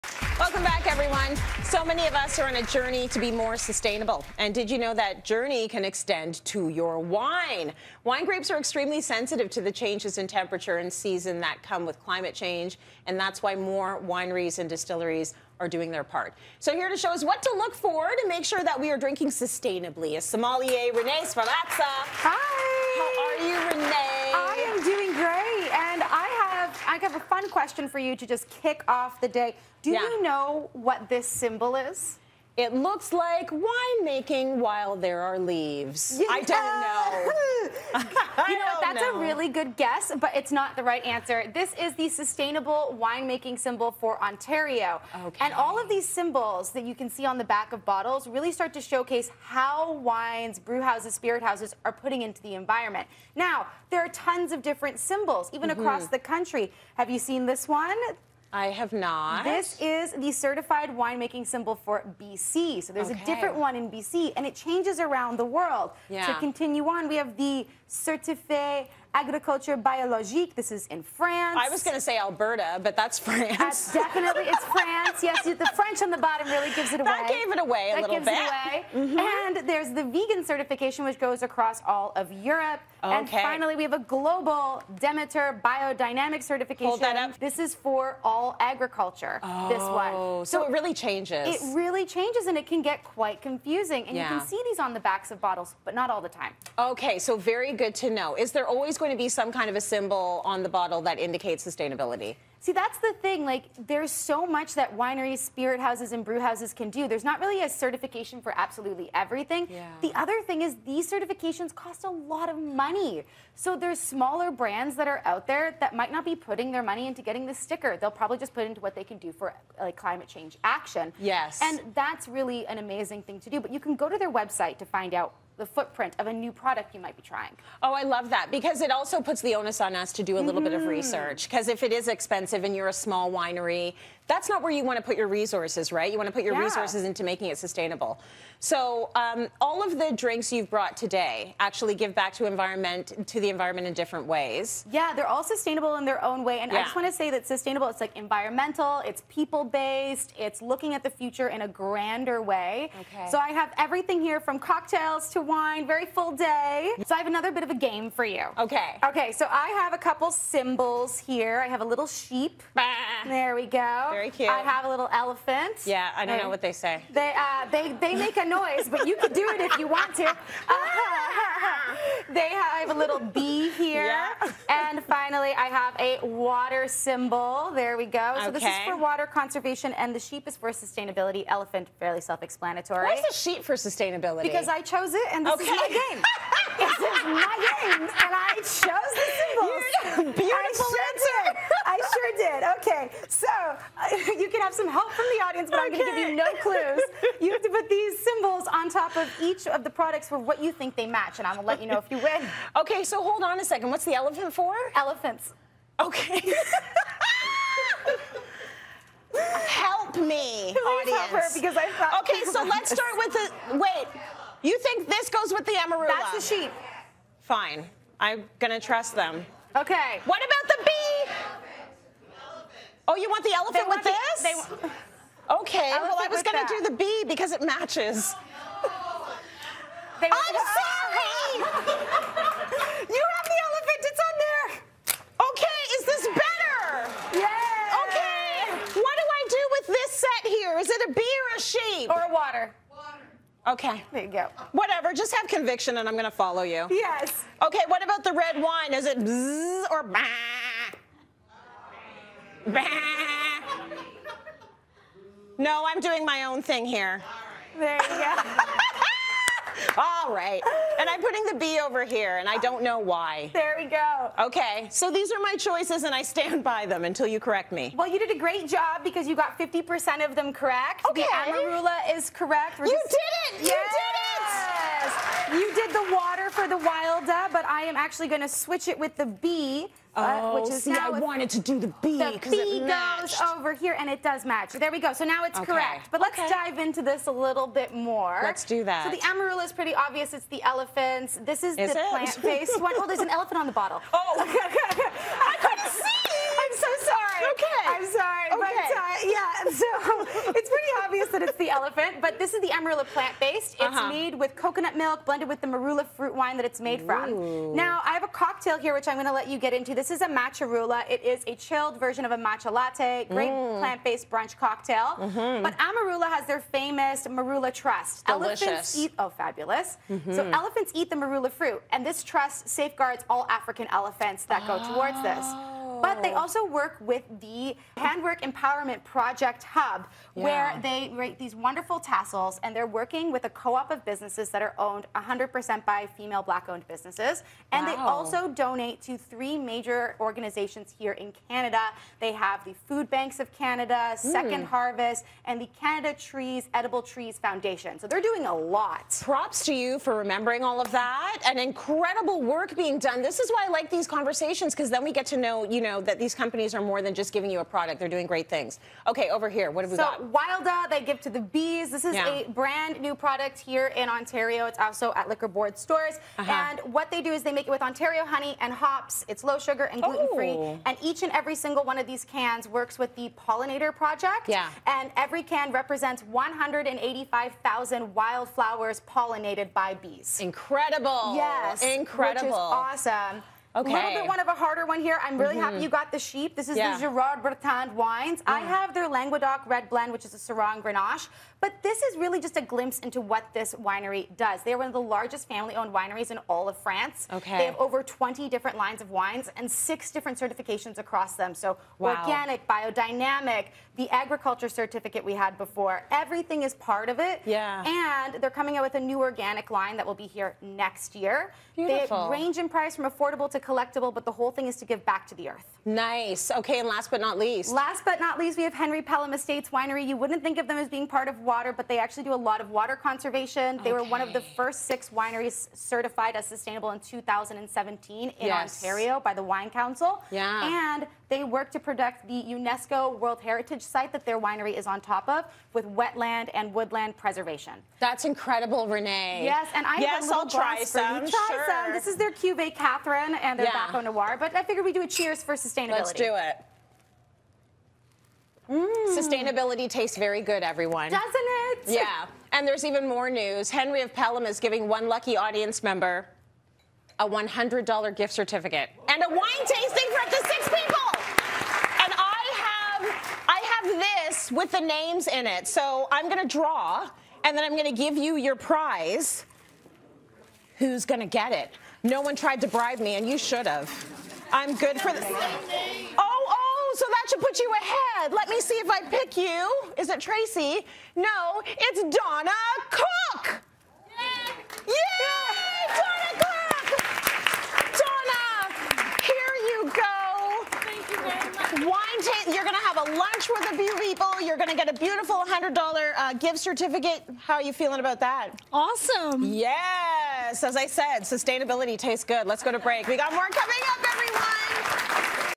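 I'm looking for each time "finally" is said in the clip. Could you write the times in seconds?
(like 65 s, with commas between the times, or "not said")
83 s, 175 s.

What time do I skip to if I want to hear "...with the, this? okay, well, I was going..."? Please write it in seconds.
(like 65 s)
224 s.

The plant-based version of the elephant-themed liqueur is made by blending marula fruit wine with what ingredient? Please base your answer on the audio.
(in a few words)
coconut milk.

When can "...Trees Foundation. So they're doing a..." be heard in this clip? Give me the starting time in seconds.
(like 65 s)
347 s.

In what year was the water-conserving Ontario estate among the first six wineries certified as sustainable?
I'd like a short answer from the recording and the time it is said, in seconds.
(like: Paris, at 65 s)
2017, at 426 s.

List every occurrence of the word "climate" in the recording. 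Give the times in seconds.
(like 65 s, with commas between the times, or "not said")
12 s, 119 s.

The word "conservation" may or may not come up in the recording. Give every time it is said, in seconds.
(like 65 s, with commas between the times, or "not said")
179 s, 422 s.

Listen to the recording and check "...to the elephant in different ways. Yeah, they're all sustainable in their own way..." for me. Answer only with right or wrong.
wrong.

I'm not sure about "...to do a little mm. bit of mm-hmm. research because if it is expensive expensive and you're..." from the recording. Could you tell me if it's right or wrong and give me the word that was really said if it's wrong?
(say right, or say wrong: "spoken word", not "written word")
right.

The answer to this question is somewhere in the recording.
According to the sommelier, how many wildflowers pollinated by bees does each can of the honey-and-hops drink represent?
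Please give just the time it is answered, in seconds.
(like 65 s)
376 s.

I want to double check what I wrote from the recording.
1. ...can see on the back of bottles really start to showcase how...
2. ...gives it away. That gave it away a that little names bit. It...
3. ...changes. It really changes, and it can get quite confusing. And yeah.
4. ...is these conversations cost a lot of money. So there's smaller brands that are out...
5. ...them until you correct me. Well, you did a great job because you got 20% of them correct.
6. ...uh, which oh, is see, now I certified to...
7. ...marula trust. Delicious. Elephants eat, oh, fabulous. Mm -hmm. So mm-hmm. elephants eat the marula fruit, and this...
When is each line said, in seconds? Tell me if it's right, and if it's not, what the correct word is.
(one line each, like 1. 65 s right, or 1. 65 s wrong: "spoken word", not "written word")
1. 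46 s right
2. 76 s wrong: "gives", not "names"
3. 91 s right
4. 110 s wrong: "certifications", not "conversations"
5. 266 s wrong: "50", not "20"
6. 280 s wrong: "wanted", not "certified"
7. 317 s right.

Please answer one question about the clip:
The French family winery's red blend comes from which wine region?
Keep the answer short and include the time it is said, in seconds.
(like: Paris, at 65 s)
Languedoc, at 389 s.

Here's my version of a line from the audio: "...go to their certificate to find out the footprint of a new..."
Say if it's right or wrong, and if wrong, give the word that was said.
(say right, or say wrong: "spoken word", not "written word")
wrong: "website", not "certificate".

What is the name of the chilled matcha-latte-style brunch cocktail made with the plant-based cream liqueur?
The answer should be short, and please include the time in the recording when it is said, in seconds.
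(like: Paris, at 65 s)
Matcharula, at 310 s.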